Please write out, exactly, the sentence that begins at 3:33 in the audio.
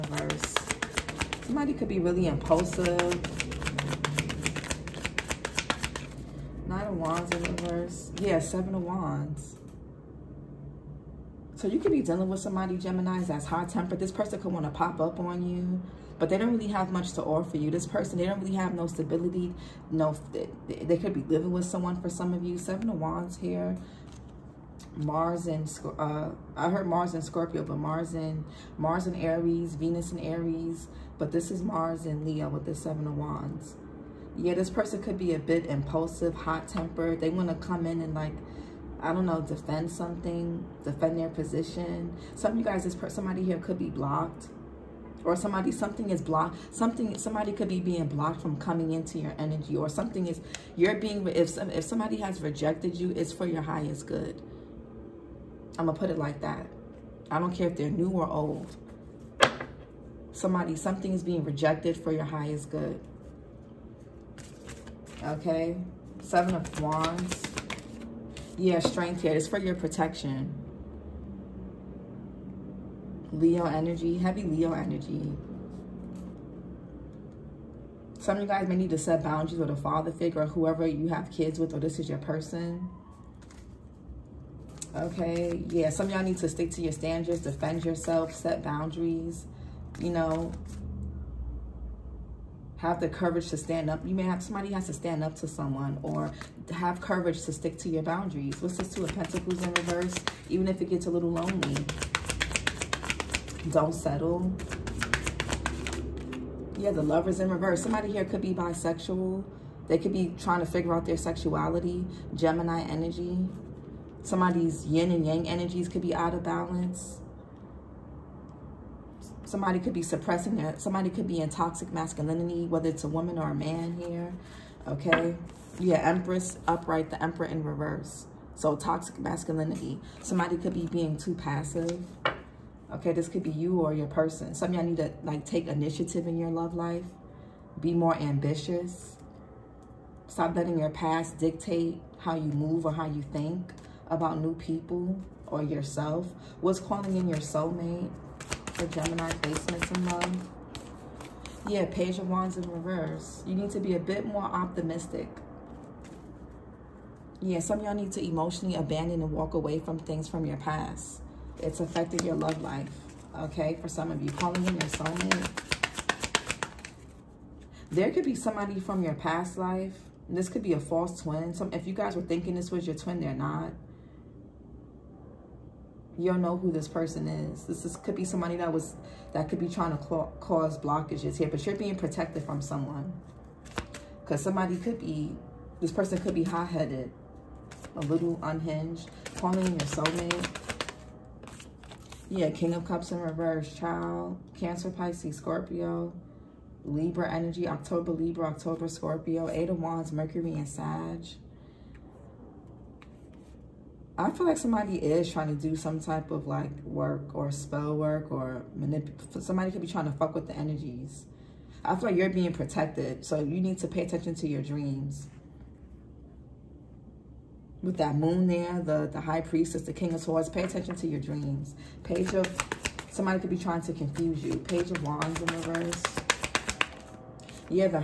So you need to pay attention to your dreams.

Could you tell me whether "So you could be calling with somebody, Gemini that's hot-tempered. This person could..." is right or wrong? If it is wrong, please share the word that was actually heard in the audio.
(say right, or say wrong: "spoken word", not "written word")
wrong: "dealing", not "calling".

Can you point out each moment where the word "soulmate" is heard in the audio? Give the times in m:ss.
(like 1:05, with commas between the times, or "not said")
2:27, 2:44, 3:09.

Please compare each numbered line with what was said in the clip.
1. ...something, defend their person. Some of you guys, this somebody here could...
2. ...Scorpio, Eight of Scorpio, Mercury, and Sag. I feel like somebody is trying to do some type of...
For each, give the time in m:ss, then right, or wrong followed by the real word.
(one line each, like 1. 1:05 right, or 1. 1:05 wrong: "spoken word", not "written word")
1. 0:39 wrong: "position", not "person"
2. 3:18 wrong: "Wands", not "Scorpio".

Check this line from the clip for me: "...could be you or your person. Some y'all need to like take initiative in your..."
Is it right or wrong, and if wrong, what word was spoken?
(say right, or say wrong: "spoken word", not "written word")
right.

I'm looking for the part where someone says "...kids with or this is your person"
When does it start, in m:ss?
1:21.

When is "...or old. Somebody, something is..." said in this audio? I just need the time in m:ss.
0:58.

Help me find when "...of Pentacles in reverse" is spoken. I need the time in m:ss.
1:39.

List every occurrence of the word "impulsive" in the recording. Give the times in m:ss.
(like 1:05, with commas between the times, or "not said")
0:02, 0:35.